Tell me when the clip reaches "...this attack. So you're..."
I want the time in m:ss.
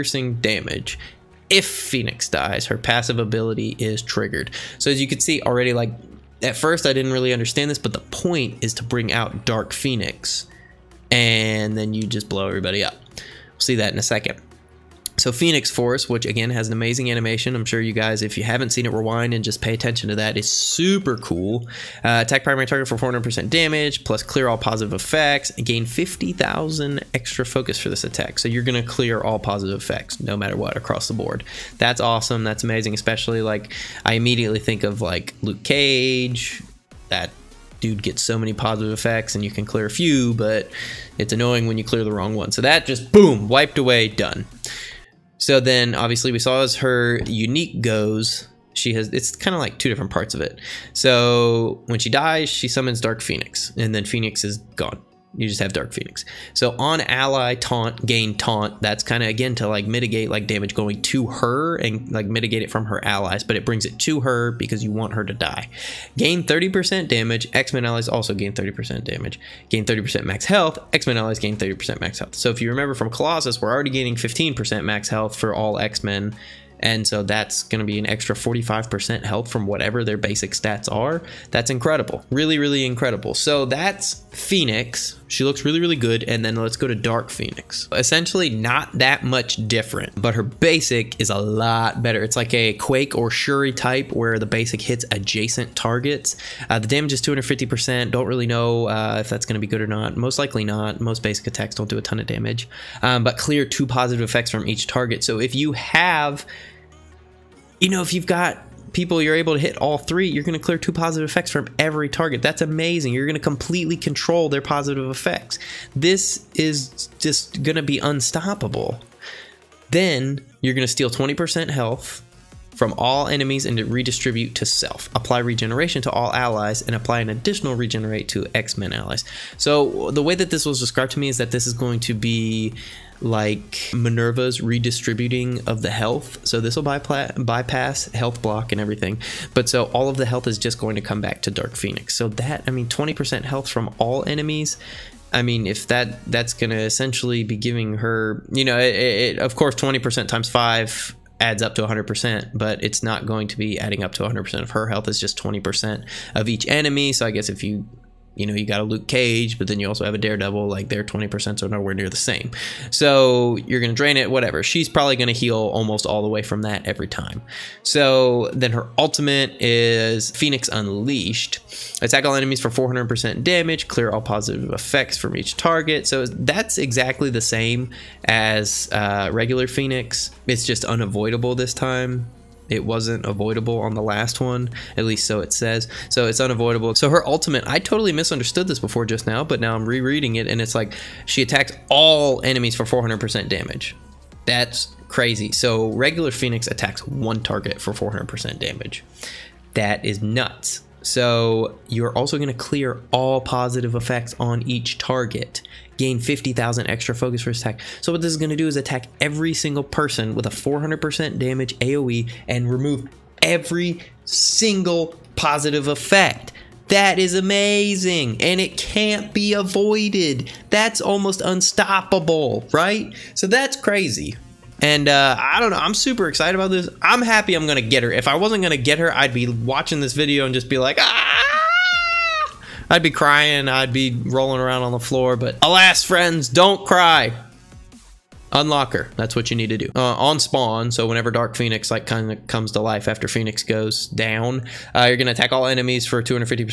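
0:27.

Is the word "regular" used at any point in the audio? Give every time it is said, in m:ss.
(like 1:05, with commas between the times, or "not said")
2:59, 3:15.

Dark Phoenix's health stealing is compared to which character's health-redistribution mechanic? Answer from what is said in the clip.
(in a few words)
Minerva.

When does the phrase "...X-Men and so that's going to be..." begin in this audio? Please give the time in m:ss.
1:15.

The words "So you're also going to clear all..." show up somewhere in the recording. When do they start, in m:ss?
3:21.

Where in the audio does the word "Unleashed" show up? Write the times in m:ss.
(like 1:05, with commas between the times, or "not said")
2:50.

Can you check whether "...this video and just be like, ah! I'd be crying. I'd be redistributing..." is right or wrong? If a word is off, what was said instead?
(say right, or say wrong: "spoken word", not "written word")
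wrong: "rolling", not "redistributing".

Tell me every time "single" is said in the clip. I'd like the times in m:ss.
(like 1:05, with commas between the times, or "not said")
3:29, 3:34.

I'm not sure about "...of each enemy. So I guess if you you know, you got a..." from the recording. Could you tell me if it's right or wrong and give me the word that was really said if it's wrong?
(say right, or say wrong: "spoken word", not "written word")
right.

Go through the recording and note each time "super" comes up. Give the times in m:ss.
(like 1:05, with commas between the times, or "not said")
0:20, 3:45.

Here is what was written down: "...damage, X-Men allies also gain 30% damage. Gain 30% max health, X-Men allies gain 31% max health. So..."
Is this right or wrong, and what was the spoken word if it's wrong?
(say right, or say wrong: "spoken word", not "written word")
wrong: "30", not "31".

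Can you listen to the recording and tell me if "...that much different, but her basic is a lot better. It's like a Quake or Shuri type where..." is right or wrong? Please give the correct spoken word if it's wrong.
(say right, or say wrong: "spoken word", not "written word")
right.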